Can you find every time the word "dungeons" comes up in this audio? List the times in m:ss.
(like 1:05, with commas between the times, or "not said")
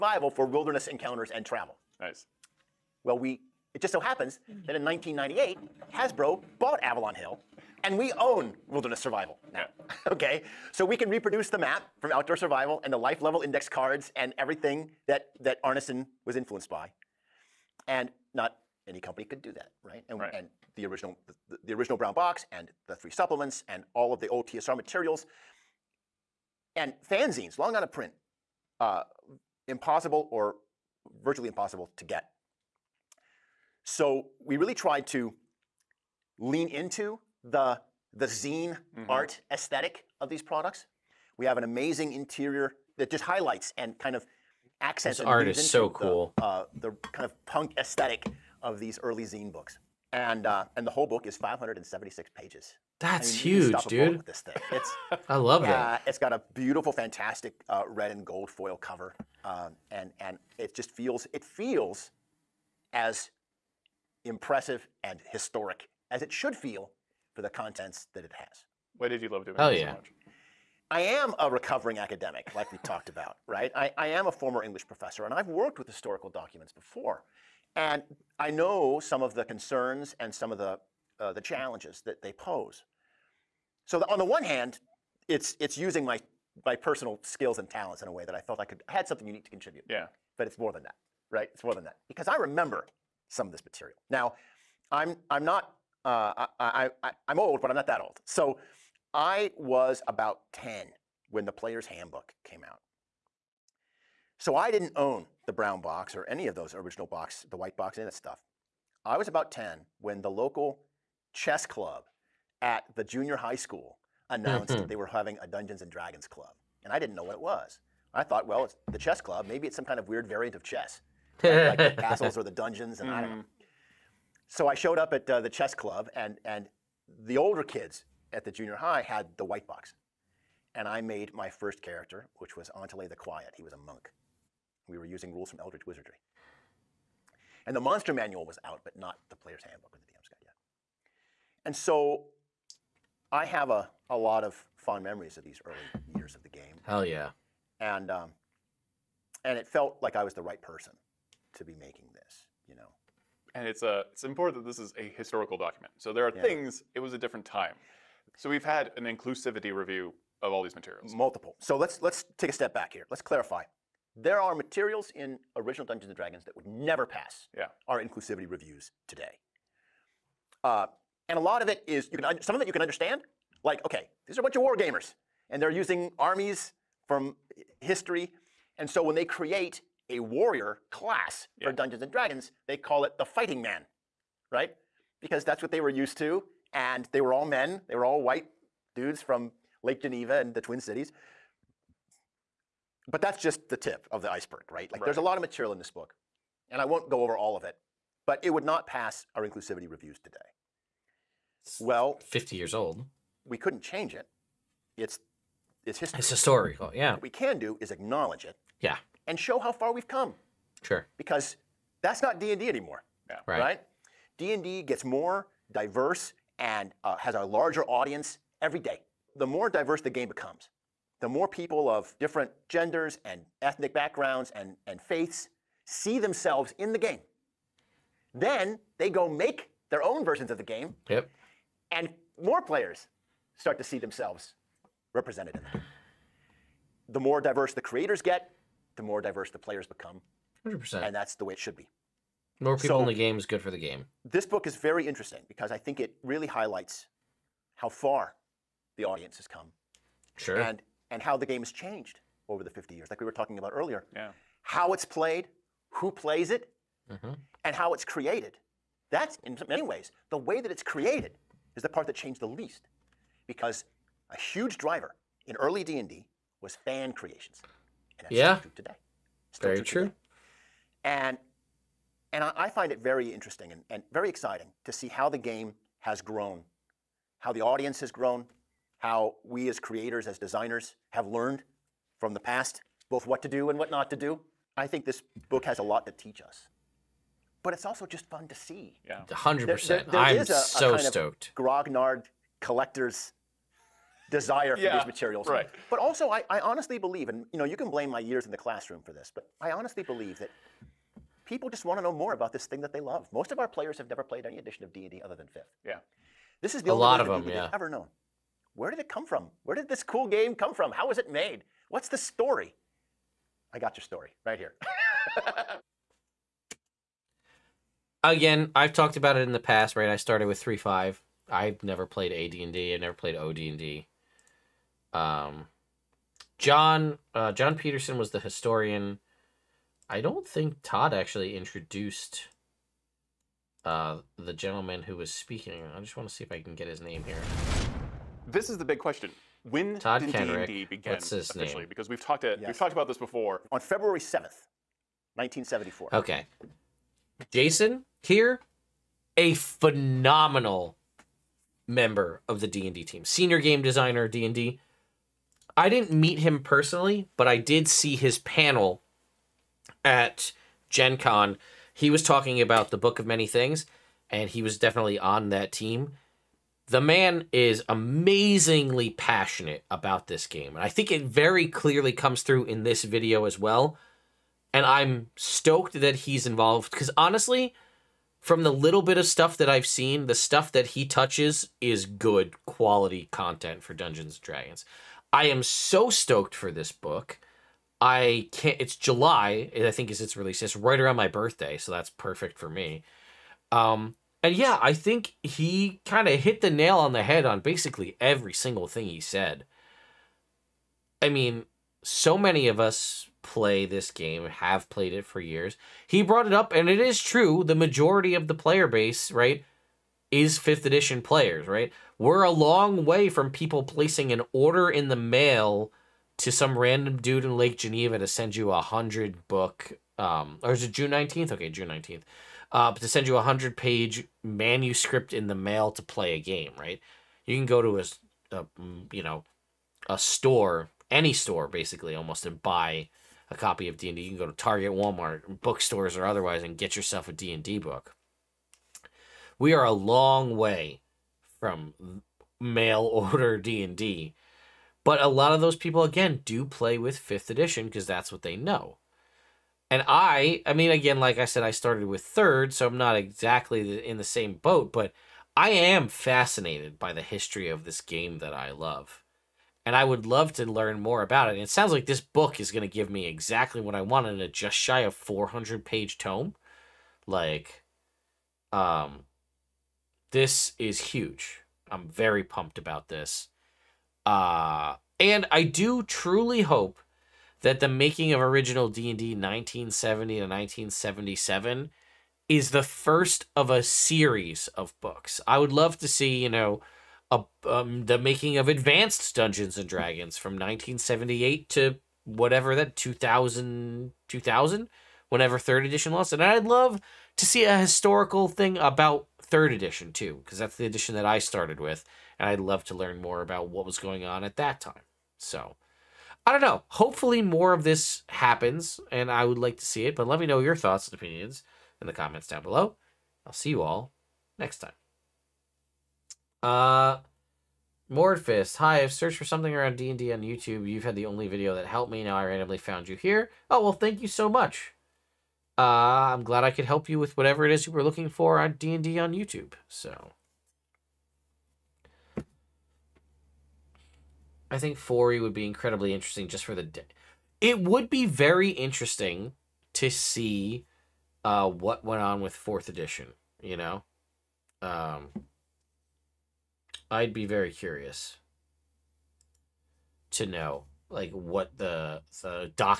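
1:55, 2:02, 2:45, 3:01, 6:23, 8:09.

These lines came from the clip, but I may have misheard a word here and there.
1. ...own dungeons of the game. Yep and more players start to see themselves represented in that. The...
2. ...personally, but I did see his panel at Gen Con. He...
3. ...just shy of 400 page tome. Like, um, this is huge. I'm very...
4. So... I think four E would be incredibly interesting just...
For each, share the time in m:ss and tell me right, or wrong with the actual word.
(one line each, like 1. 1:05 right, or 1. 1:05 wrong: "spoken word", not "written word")
1. 3:50 wrong: "versions", not "dungeons"
2. 5:56 right
3. 7:44 right
4. 8:49 right.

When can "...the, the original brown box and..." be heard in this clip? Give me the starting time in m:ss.
0:21.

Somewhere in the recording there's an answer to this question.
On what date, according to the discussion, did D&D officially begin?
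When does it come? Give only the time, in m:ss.
5:43.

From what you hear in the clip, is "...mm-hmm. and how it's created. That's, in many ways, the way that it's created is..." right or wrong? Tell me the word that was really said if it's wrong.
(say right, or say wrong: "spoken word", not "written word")
right.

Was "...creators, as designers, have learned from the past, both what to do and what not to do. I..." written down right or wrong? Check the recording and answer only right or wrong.
right.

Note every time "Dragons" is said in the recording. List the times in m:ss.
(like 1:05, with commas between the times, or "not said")
1:55, 2:46, 3:02, 6:24, 8:09.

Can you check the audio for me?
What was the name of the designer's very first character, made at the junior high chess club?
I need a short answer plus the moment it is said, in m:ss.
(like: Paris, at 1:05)
Antele the Quiet, at 2:12.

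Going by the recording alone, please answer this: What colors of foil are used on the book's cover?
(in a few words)
Red and gold.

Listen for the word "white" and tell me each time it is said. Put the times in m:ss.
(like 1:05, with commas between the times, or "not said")
1:47, 2:09, 3:08.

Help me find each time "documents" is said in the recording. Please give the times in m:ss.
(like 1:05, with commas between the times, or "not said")
1:16, 2:35.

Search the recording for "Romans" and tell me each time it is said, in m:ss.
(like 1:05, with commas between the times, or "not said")
not said.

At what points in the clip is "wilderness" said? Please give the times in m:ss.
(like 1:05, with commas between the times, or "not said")
0:00, 0:08.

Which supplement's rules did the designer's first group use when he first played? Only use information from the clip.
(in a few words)
Eldritch Wizardry.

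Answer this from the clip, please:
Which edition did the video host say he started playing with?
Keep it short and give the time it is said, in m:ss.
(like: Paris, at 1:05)
3.5, at 5:20.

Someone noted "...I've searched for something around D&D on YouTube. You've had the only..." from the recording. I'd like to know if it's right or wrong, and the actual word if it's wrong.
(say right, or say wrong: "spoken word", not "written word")
right.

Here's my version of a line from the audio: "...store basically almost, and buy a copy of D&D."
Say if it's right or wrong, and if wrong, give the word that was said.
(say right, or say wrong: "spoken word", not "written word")
right.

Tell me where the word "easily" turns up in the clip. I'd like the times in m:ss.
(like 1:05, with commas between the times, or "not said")
not said.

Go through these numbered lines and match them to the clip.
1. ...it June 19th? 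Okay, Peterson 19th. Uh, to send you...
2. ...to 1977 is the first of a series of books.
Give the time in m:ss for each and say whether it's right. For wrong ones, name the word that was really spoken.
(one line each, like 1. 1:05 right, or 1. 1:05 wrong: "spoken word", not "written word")
1. 7:00 wrong: "June", not "Peterson"
2. 8:00 right.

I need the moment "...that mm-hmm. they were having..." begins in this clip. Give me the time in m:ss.
1:54.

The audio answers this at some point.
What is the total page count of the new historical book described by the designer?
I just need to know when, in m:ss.
0:51.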